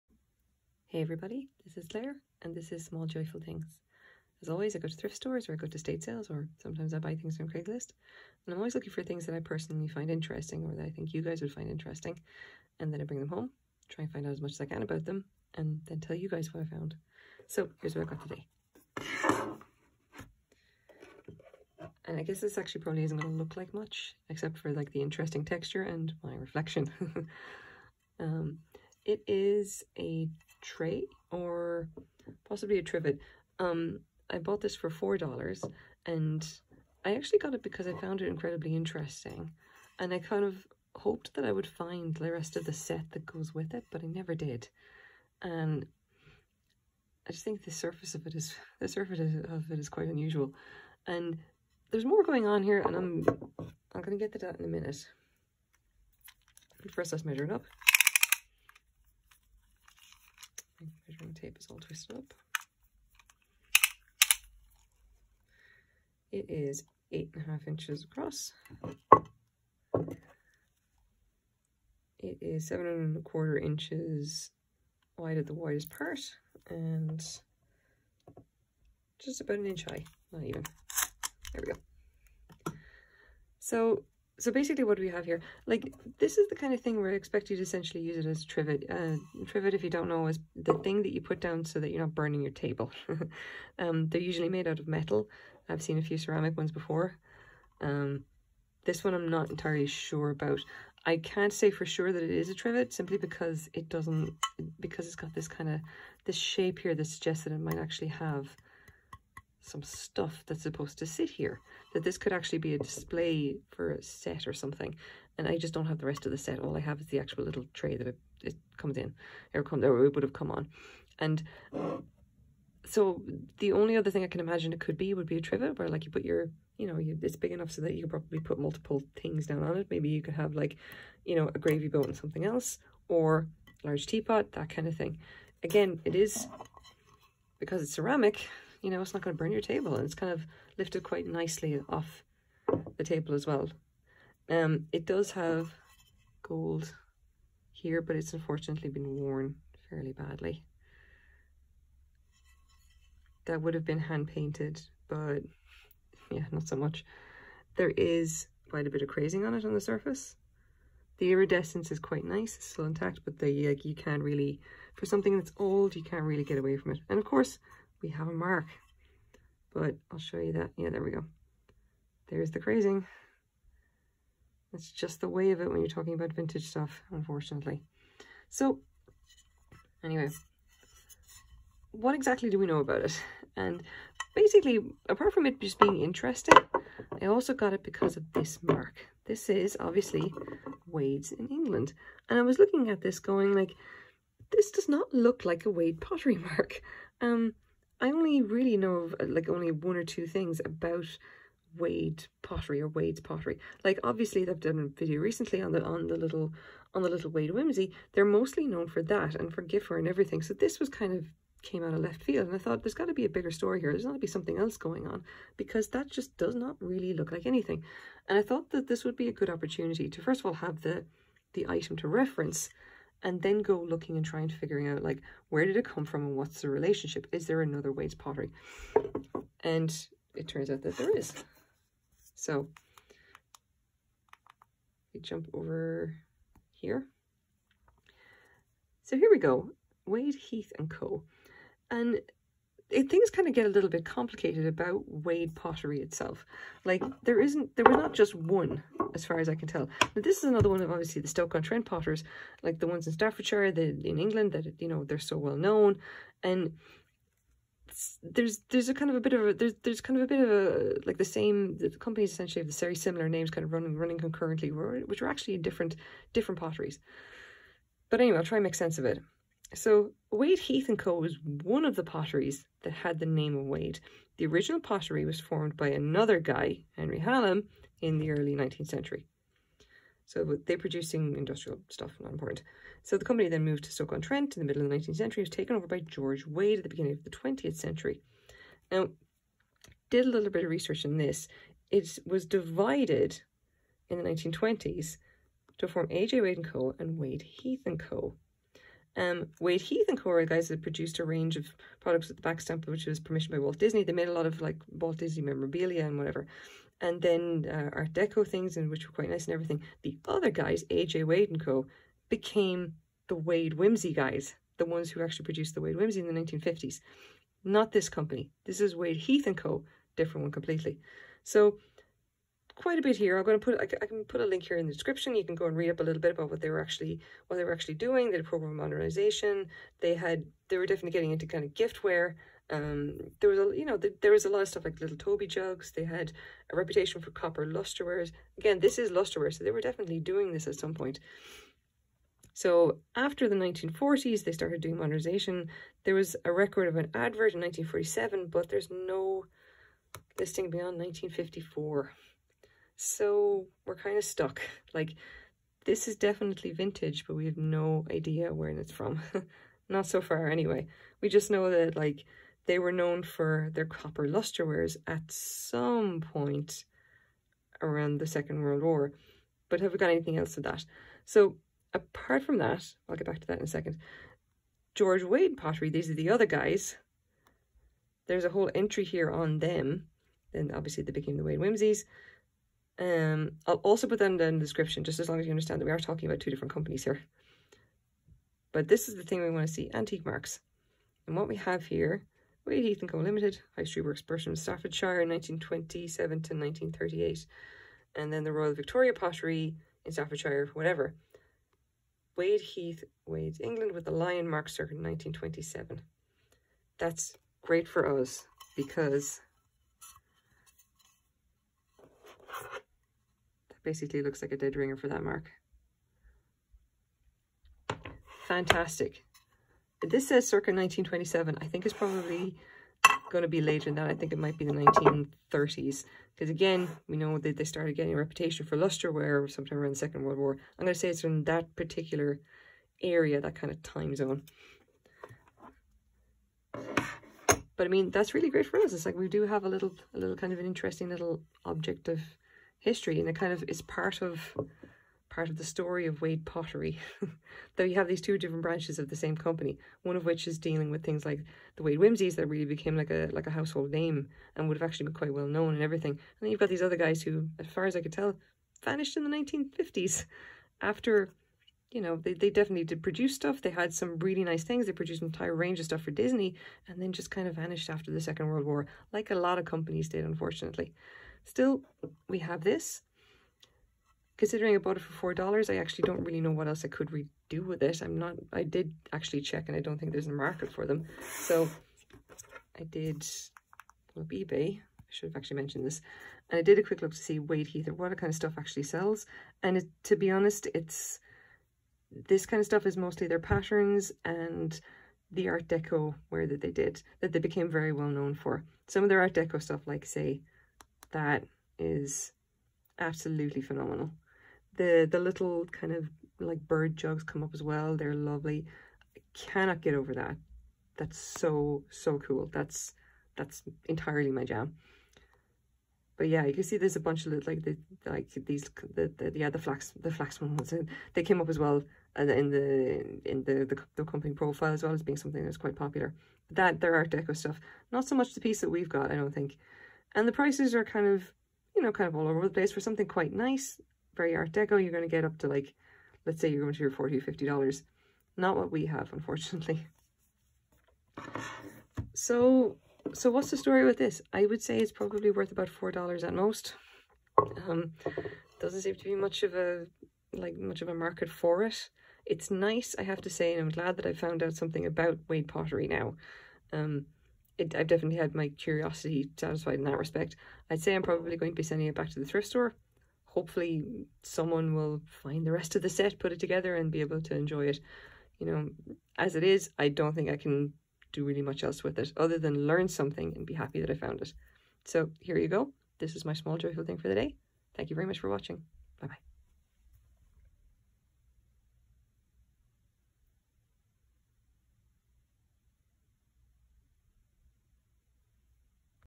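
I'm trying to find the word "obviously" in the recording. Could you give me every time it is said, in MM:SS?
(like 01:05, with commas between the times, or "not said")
03:09, 03:24, 04:10, 06:20.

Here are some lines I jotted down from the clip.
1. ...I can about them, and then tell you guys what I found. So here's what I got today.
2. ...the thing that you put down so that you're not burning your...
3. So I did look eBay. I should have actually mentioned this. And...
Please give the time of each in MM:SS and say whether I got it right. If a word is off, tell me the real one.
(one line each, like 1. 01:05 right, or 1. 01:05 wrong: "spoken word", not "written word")
1. 00:14 right
2. 01:30 right
3. 08:01 right.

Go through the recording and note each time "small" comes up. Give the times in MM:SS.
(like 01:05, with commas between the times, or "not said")
00:02, 09:36.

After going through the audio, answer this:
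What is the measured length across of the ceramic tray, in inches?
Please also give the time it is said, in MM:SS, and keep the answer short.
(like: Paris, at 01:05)
8.5 inches, at 01:07.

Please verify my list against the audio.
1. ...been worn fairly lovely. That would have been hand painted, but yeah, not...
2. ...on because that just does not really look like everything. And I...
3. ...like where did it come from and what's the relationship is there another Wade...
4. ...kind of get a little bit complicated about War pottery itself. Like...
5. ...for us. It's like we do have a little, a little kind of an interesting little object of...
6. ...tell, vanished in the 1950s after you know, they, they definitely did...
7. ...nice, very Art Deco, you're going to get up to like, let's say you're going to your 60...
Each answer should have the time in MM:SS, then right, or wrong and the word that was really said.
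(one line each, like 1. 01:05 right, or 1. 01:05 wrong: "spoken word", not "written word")
1. 02:28 wrong: "badly", not "lovely"
2. 03:35 wrong: "anything", not "everything"
3. 03:45 right
4. 04:03 wrong: "Wade", not "War"
5. 07:18 right
6. 07:38 right
7. 08:53 wrong: "40", not "60".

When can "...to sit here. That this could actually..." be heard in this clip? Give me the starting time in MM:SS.
01:50.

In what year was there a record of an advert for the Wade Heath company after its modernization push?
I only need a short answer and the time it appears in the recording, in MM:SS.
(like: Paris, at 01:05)
1947, at 05:47.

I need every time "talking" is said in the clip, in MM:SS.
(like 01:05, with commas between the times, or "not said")
02:55, 06:25.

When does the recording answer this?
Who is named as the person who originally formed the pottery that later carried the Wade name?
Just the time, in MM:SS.
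04:36.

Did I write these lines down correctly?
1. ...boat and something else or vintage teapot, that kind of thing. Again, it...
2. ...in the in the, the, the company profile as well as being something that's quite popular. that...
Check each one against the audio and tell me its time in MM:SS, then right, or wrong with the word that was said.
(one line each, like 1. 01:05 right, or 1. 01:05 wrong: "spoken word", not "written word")
1. 02:11 wrong: "large", not "vintage"
2. 08:42 right.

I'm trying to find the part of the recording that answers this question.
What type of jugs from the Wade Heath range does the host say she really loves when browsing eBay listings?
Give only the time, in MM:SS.
08:26.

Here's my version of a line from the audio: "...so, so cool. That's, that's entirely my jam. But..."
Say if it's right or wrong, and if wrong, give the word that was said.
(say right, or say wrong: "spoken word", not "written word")
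right.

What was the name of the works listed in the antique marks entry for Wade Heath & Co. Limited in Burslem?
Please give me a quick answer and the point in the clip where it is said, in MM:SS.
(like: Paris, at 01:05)
High Street Works, at 06:33.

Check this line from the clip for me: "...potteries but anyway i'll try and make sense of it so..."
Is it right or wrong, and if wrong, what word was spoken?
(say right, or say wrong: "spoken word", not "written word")
right.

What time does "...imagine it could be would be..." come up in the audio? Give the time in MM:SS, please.
02:04.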